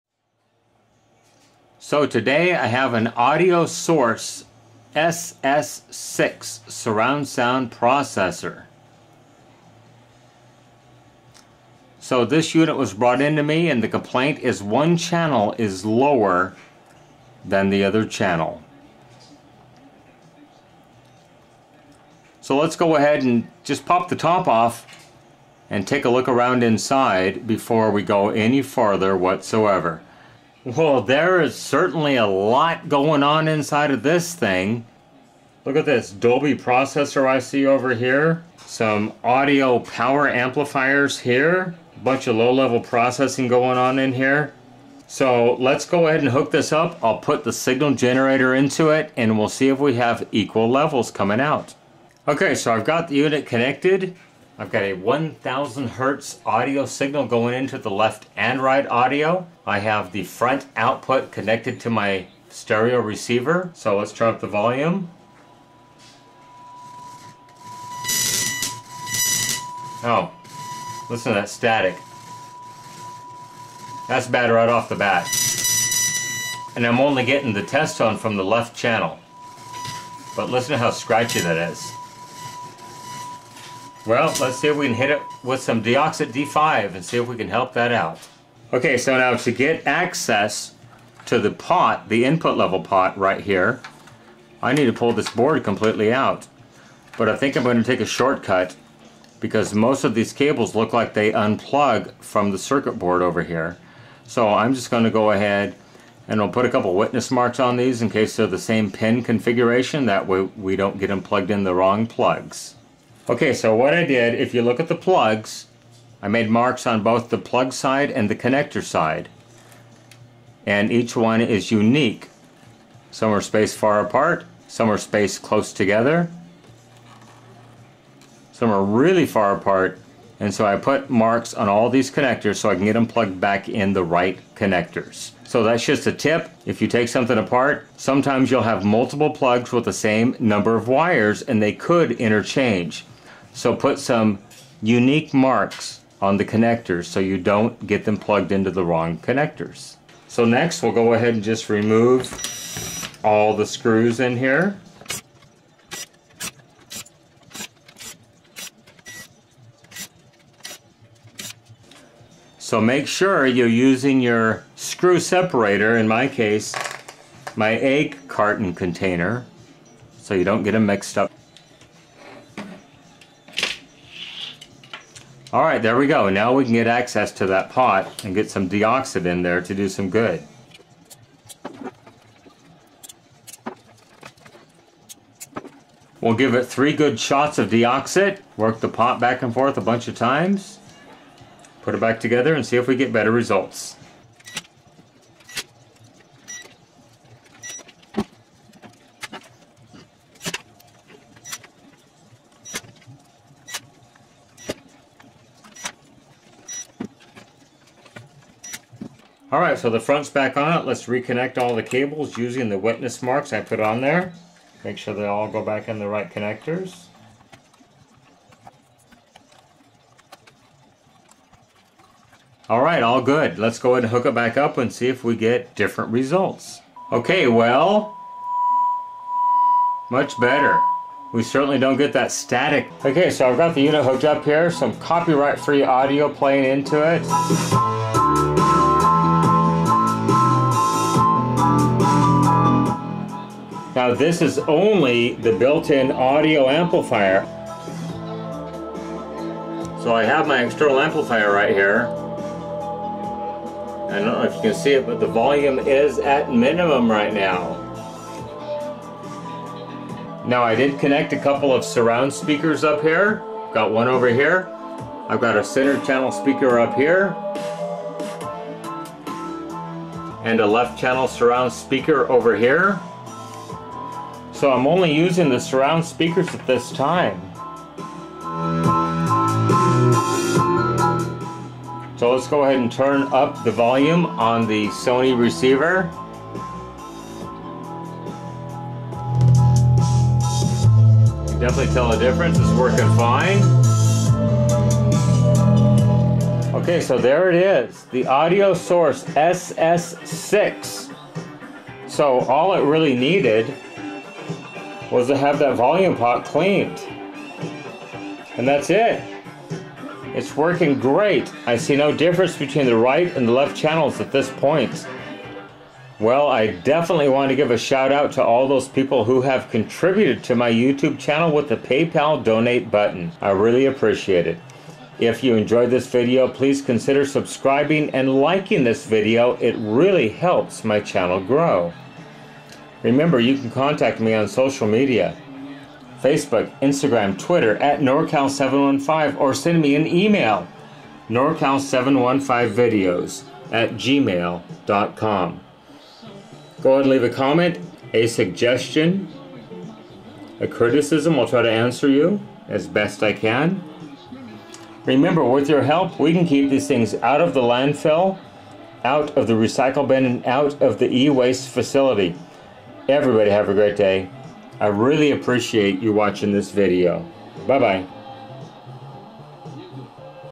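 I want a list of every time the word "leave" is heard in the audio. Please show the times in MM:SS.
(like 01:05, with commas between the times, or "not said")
05:47.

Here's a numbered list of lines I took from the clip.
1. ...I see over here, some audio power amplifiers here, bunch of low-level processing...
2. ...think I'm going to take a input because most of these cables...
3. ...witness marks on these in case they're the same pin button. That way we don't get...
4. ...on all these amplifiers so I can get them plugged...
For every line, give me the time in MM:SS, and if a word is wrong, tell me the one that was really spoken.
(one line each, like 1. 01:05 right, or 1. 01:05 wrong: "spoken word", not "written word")
1. 00:37 right
2. 01:37 wrong: "shortcut", not "input"
3. 01:46 wrong: "configuration", not "button"
4. 02:11 wrong: "connectors", not "amplifiers".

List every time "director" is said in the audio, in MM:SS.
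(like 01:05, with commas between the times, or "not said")
not said.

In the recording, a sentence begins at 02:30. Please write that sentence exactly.
So next we'll go ahead and just remove all the screws in here.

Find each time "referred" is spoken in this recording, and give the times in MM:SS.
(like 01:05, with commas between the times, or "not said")
not said.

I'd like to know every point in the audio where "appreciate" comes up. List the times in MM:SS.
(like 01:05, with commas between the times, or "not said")
05:23, 06:05.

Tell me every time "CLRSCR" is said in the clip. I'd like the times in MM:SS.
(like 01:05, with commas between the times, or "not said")
not said.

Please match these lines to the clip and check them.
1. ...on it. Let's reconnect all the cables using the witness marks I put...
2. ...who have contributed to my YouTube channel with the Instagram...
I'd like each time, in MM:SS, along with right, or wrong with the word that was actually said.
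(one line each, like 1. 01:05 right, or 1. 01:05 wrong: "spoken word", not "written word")
1. 03:30 right
2. 05:19 wrong: "PayPal", not "Instagram".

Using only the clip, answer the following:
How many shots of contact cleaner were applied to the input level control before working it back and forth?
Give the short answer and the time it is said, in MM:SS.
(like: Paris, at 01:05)
3, at 03:06.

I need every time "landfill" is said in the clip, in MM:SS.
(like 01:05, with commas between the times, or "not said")
05:57.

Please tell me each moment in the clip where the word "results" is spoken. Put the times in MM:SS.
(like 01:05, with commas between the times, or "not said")
03:13, 03:46.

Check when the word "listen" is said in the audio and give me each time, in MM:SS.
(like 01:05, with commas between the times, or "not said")
01:11, 01:20.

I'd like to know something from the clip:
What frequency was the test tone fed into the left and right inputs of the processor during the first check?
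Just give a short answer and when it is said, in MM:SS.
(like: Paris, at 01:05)
1000 hertz, at 00:54.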